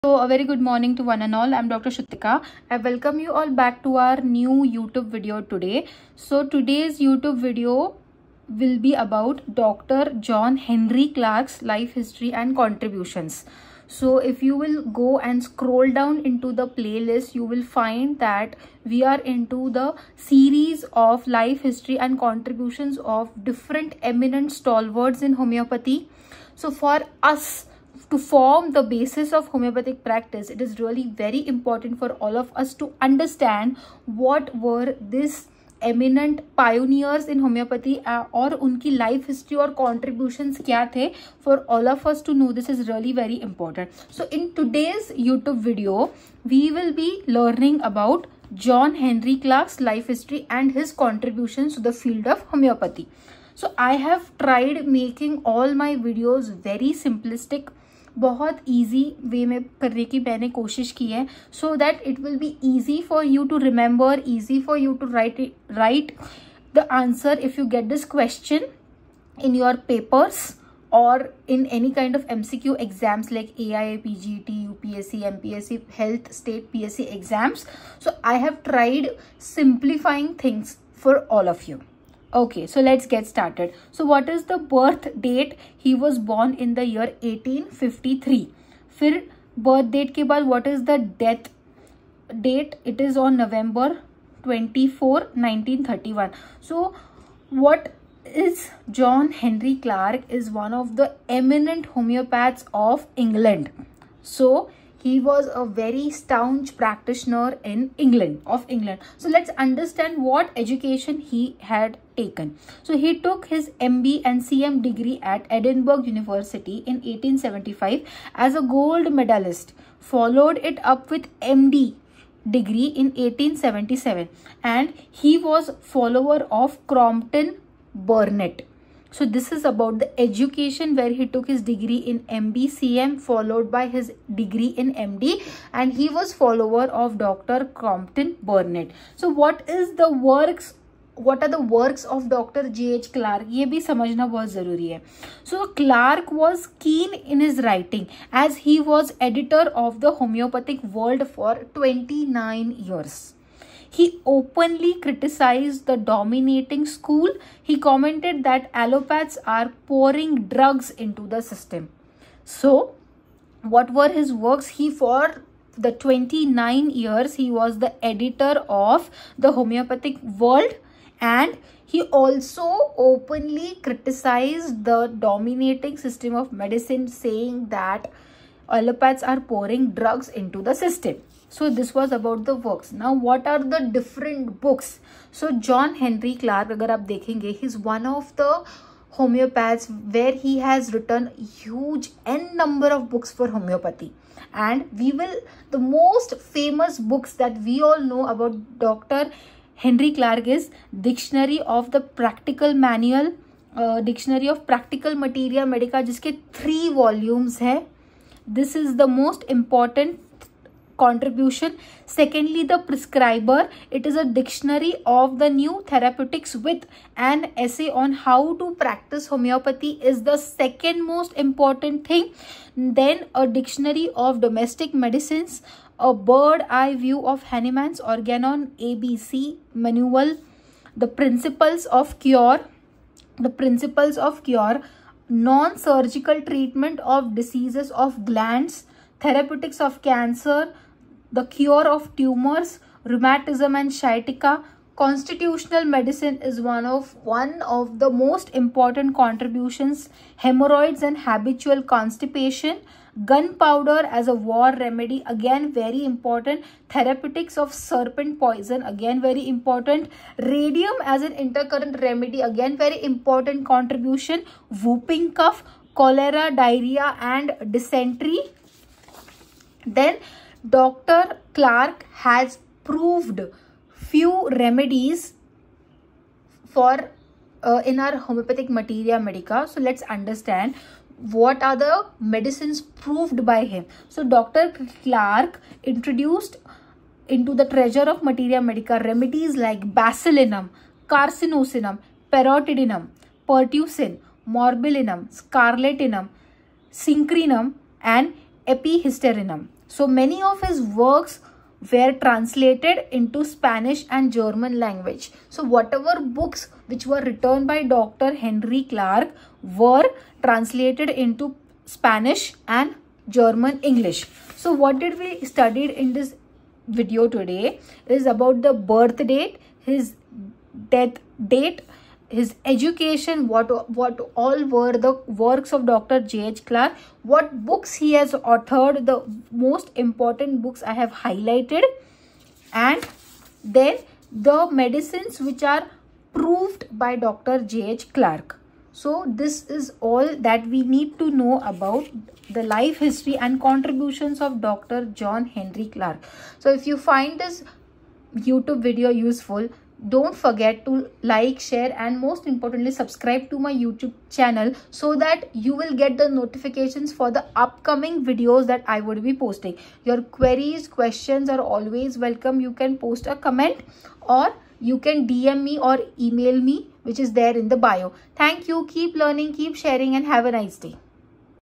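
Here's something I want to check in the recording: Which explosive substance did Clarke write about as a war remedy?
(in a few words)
Gunpowder.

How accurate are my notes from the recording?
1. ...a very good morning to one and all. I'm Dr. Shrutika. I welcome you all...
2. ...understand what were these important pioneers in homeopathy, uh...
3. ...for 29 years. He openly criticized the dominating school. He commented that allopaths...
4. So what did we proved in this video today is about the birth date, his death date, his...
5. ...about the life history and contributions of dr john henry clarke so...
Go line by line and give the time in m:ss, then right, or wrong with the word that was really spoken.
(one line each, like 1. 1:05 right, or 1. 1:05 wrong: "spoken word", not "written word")
1. 0:00 right
2. 0:33 wrong: "eminent", not "important"
3. 2:31 right
4. 5:14 wrong: "studied", not "proved"
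5. 5:41 right.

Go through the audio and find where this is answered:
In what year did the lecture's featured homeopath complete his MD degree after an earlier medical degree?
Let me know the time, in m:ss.
2:03.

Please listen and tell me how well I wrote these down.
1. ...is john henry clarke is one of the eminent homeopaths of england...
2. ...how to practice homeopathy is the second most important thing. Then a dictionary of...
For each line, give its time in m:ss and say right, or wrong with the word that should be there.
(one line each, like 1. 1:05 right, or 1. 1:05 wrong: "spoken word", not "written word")
1. 1:38 right
2. 3:38 right.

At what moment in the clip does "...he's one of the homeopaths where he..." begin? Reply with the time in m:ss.
3:07.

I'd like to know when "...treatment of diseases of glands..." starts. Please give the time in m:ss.
3:56.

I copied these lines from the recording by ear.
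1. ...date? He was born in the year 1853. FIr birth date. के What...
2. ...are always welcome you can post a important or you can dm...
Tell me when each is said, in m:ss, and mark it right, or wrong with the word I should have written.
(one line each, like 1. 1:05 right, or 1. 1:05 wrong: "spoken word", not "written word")
1. 1:25 right
2. 6:01 wrong: "comment", not "important".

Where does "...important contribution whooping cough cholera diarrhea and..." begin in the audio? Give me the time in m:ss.
4:23.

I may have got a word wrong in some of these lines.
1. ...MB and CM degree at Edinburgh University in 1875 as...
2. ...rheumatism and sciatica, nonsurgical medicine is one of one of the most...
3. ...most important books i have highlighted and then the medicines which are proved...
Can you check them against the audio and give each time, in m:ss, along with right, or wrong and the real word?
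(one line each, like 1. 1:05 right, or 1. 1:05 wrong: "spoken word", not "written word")
1. 1:53 right
2. 4:03 wrong: "constitutional", not "nonsurgical"
3. 5:29 right.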